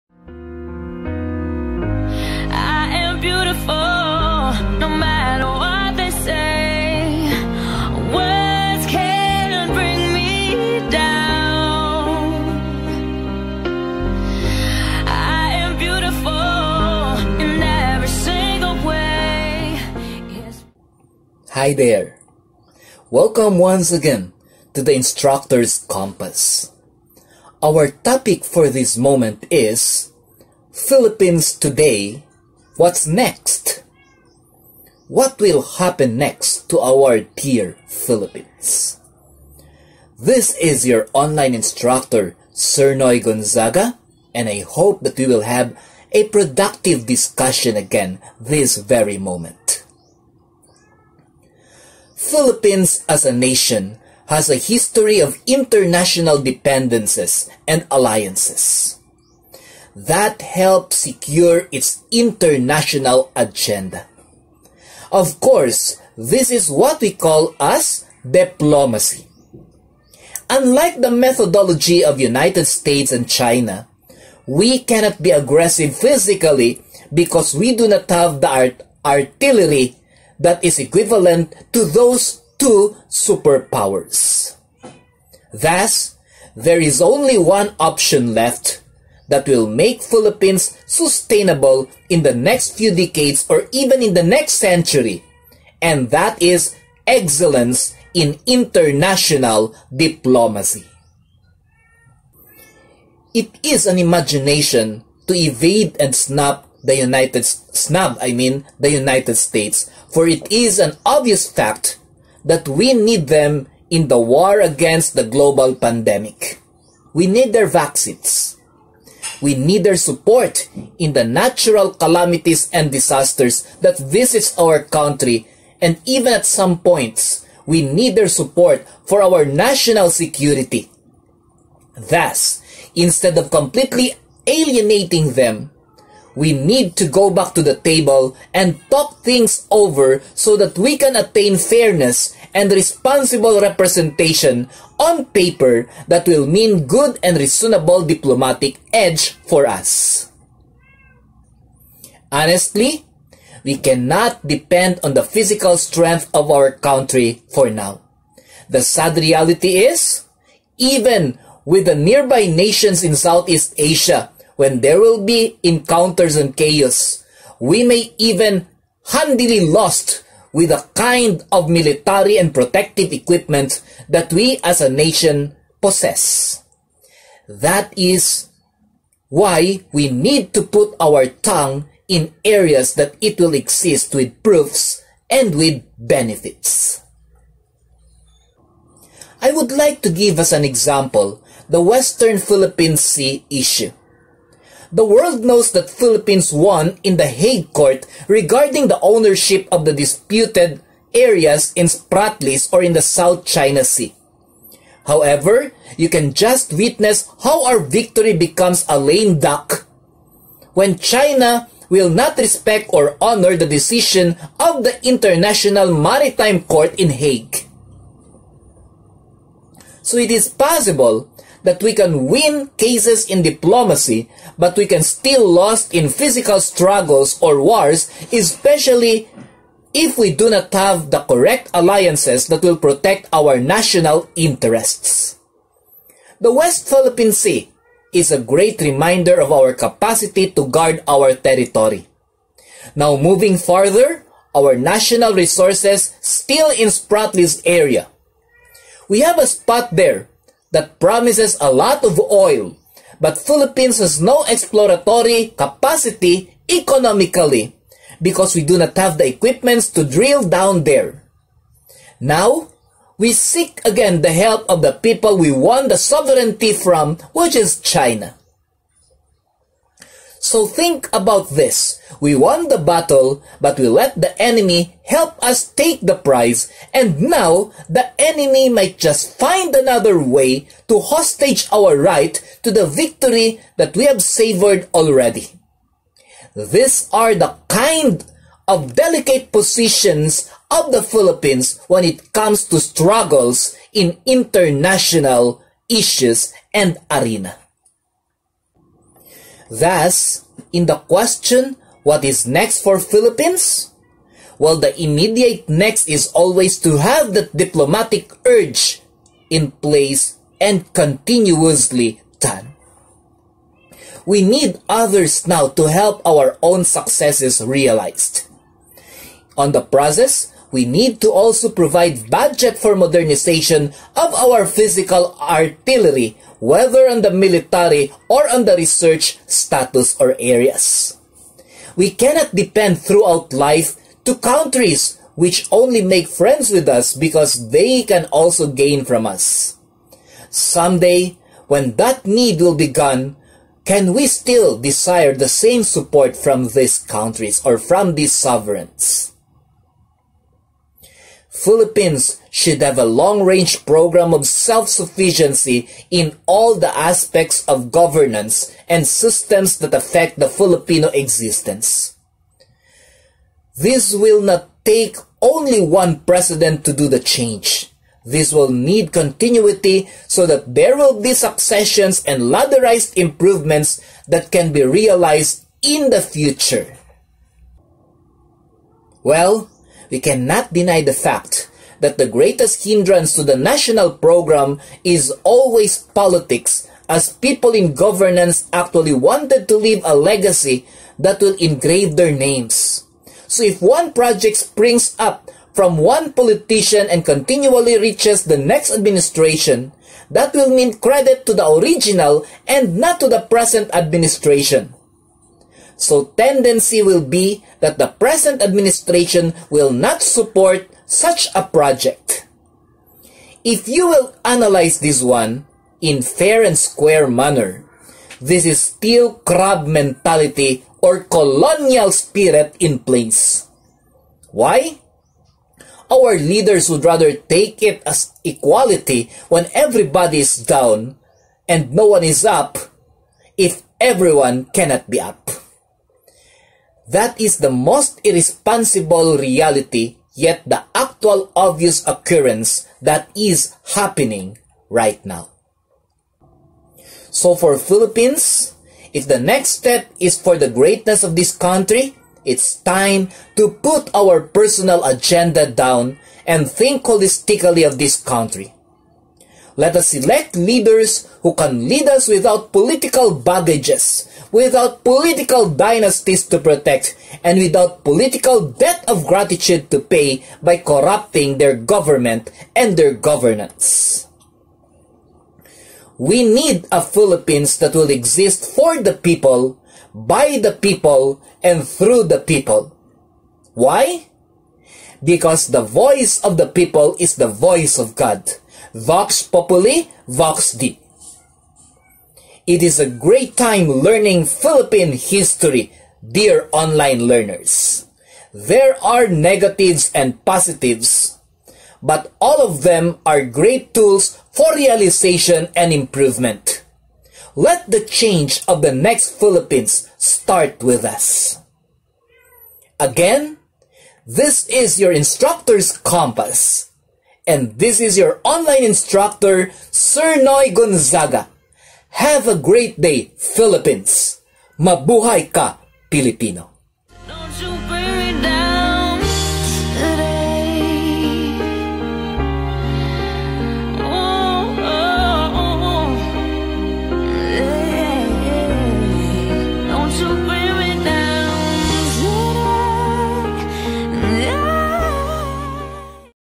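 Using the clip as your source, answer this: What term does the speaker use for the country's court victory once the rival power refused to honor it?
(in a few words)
lame duck.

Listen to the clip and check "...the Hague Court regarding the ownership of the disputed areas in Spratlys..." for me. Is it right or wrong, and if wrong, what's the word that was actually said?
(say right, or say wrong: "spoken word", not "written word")
right.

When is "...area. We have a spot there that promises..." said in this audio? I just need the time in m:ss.
4:07.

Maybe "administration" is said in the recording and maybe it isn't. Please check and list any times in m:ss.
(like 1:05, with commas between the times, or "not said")
6:38, 6:43, 6:48.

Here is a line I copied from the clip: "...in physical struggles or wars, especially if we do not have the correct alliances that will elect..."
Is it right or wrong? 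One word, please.
wrong.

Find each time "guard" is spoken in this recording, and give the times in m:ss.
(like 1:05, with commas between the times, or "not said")
4:00.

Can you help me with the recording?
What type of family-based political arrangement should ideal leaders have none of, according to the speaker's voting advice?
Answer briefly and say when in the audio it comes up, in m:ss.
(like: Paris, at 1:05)
political dynasties, at 7:45.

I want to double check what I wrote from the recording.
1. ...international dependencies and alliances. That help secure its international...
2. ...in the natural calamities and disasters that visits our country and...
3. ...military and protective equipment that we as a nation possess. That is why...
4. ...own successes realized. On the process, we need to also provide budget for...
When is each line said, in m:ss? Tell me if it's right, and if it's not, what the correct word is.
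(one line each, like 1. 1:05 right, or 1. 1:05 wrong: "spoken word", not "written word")
1. 0:55 right
2. 2:00 right
3. 2:51 right
4. 5:16 right.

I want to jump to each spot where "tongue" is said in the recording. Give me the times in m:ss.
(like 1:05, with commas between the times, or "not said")
3:01.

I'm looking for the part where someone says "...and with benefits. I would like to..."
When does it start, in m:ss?
3:05.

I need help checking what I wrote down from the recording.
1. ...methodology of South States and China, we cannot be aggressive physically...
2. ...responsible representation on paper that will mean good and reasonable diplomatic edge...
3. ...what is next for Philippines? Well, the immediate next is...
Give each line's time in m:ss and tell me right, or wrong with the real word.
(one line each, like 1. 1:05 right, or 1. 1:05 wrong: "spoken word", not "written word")
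1. 1:11 wrong: "United", not "South"
2. 2:22 right
3. 5:02 right.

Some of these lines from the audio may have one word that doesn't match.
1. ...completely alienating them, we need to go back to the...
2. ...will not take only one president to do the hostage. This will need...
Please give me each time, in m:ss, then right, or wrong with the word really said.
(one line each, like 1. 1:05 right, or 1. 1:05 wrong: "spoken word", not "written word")
1. 2:13 right
2. 6:04 wrong: "change", not "hostage".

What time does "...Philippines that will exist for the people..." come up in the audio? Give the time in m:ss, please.
7:57.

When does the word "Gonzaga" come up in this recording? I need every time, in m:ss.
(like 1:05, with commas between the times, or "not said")
0:43, 8:40.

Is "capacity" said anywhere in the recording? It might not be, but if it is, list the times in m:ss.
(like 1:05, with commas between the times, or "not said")
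3:59, 4:15.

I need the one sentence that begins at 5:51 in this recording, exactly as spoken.
Philippines should have a long-range program of self-sufficiency in all the aspects of governance and systems that affect the Filipino existence.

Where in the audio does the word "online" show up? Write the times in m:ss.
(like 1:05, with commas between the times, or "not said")
0:41, 8:16, 8:38.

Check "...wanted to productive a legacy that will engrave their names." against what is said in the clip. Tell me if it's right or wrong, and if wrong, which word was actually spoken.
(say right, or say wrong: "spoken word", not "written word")
wrong: "leave", not "productive".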